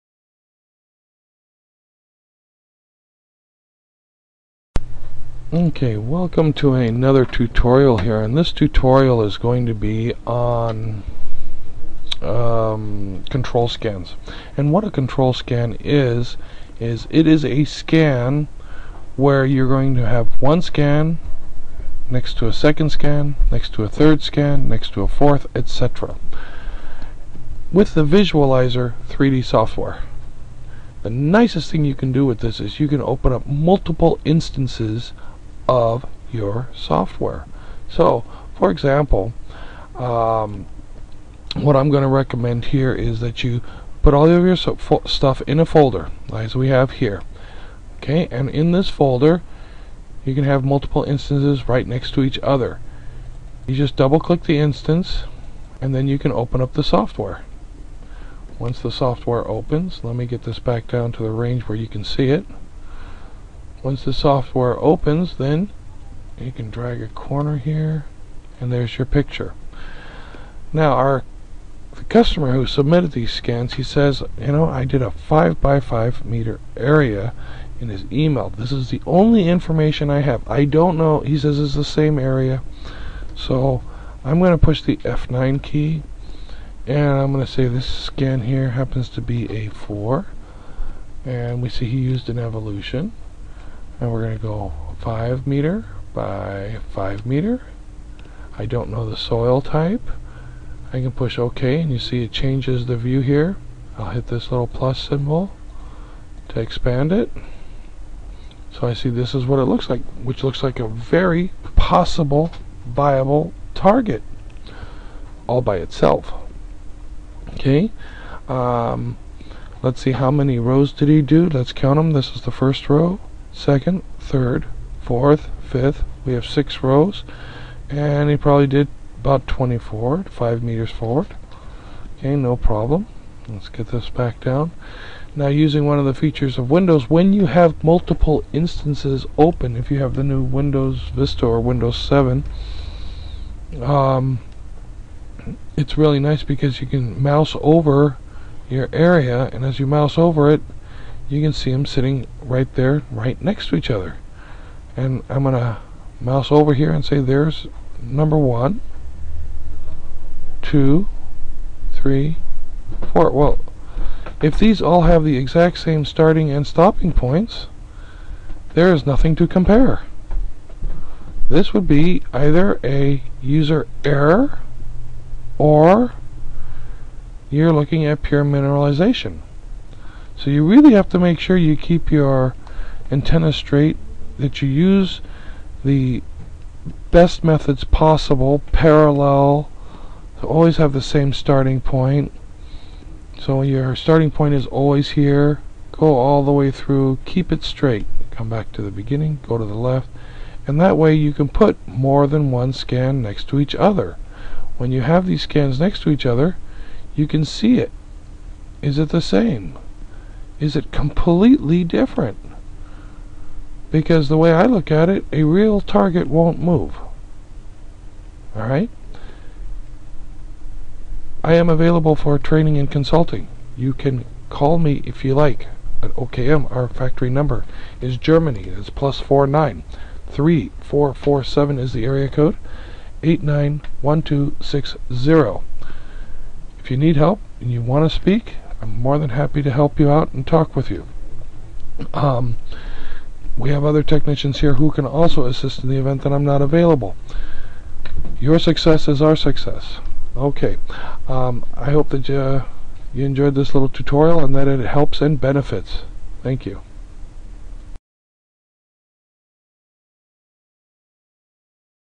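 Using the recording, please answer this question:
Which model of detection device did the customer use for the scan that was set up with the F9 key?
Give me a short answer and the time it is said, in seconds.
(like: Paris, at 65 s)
Evolution, at 92 s.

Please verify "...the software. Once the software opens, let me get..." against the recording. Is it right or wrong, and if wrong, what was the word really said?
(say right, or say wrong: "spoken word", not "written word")
right.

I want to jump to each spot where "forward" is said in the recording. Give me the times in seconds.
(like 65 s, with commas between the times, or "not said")
130 s.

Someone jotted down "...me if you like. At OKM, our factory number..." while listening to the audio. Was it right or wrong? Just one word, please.
right.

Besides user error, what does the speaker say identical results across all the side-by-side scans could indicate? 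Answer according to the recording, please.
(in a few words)
Pure mineralization.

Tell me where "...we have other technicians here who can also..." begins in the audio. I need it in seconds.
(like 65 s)
243 s.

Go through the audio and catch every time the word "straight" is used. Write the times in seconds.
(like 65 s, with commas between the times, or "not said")
183 s, 197 s.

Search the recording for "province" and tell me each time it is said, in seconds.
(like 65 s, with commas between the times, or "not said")
not said.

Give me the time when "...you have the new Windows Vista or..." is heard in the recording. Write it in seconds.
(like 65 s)
139 s.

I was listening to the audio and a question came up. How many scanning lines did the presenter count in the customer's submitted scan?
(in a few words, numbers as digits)
6.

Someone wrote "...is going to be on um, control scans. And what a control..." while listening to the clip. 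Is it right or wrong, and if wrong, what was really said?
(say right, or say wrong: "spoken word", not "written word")
right.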